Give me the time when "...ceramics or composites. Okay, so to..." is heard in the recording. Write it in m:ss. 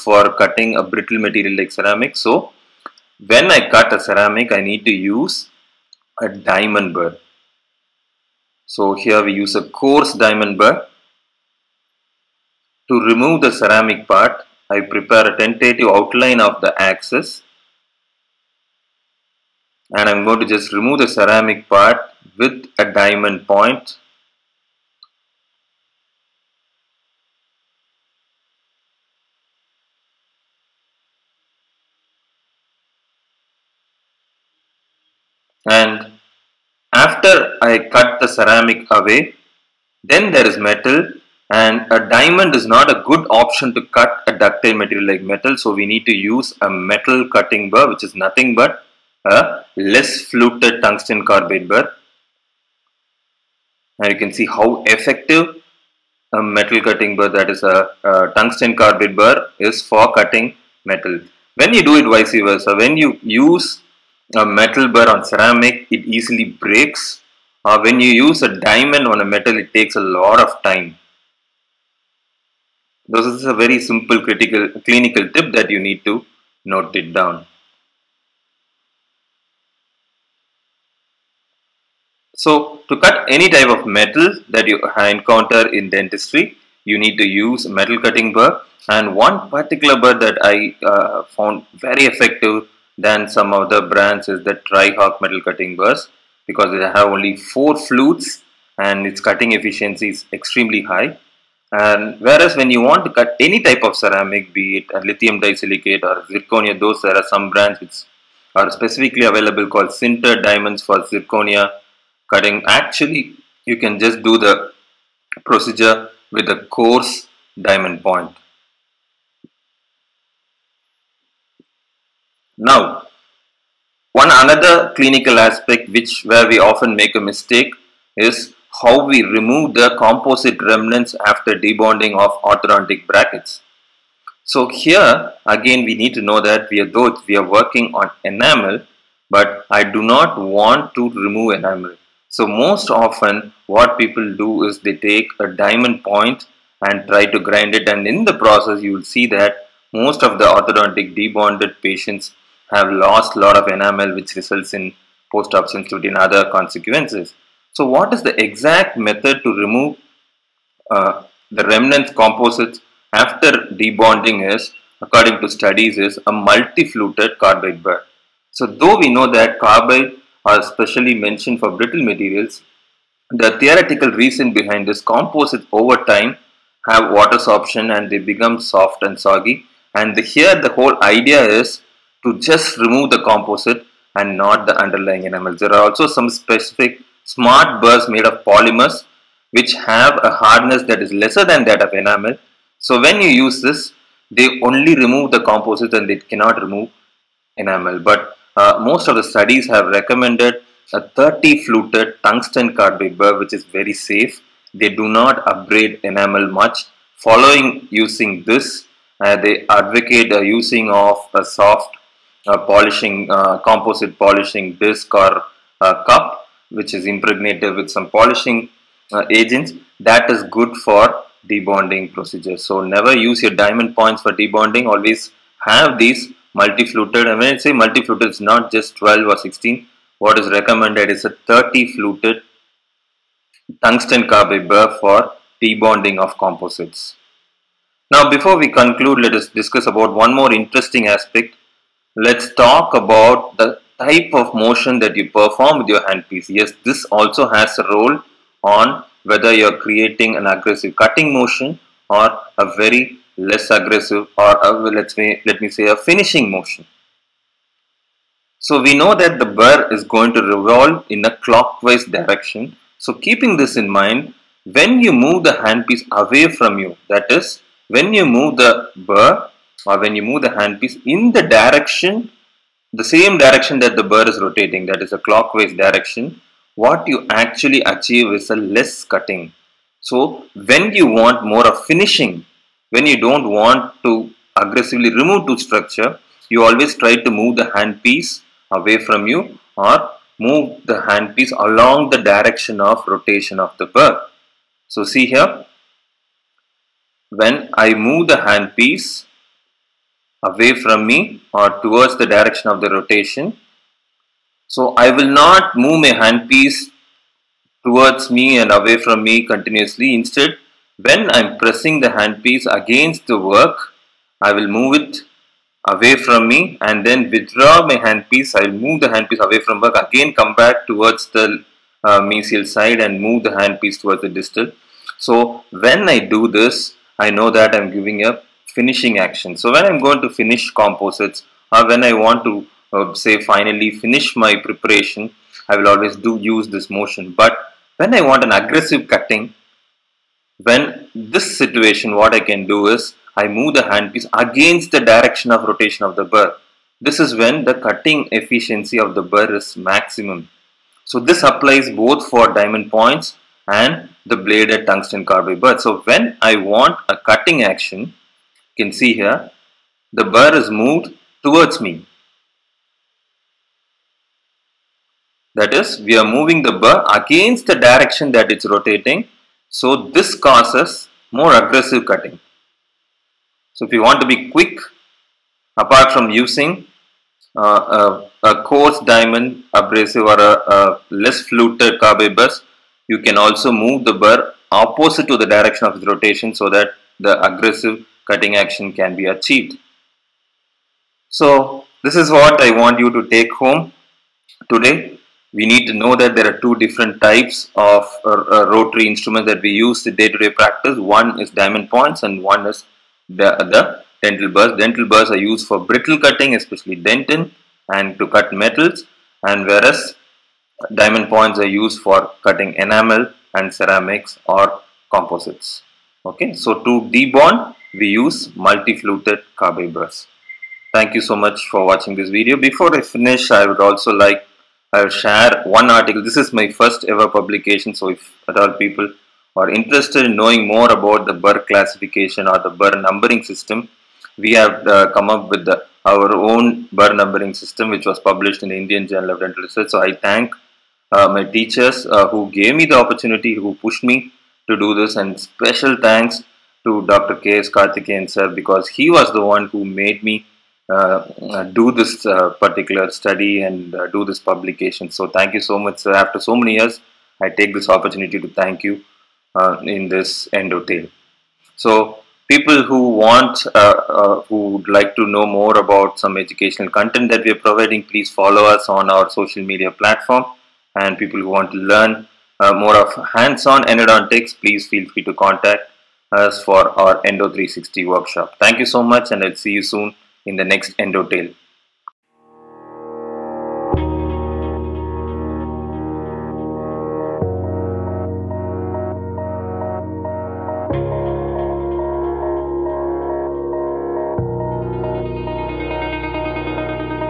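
6:53.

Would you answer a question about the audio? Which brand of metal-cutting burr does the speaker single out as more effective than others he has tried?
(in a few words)
Trihawk.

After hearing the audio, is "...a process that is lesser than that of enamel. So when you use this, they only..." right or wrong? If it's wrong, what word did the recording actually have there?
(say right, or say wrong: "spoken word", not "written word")
wrong: "hardness", not "process".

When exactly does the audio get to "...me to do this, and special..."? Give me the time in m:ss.
7:24.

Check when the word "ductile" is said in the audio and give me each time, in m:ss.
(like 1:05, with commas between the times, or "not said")
0:44.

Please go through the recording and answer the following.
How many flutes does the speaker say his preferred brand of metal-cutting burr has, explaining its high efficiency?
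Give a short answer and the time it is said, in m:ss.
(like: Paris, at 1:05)
4, at 1:37.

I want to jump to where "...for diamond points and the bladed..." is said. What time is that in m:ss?
5:52.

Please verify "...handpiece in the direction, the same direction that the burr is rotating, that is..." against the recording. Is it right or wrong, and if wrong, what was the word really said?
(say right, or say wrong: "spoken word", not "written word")
right.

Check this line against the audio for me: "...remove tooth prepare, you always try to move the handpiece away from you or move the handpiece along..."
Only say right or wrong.
wrong.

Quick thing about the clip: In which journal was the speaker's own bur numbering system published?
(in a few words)
Indian Journal of Dental Research.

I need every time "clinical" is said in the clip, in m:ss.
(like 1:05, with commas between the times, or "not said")
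1:14, 2:04.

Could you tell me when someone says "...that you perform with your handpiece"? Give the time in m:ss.
4:04.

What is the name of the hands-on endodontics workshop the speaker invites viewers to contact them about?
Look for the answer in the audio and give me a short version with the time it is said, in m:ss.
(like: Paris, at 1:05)
Endo 360, at 7:57.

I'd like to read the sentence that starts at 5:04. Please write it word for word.
So I will not move my handpiece towards me and away from me continuously.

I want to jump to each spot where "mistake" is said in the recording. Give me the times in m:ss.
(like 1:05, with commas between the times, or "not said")
2:07.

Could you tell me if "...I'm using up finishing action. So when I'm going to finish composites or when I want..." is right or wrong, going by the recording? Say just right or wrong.
wrong.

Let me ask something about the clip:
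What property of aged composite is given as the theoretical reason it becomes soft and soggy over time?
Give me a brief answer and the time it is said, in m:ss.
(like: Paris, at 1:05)
water sorption, at 2:57.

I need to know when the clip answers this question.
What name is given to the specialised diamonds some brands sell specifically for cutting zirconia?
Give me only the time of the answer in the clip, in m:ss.
1:49.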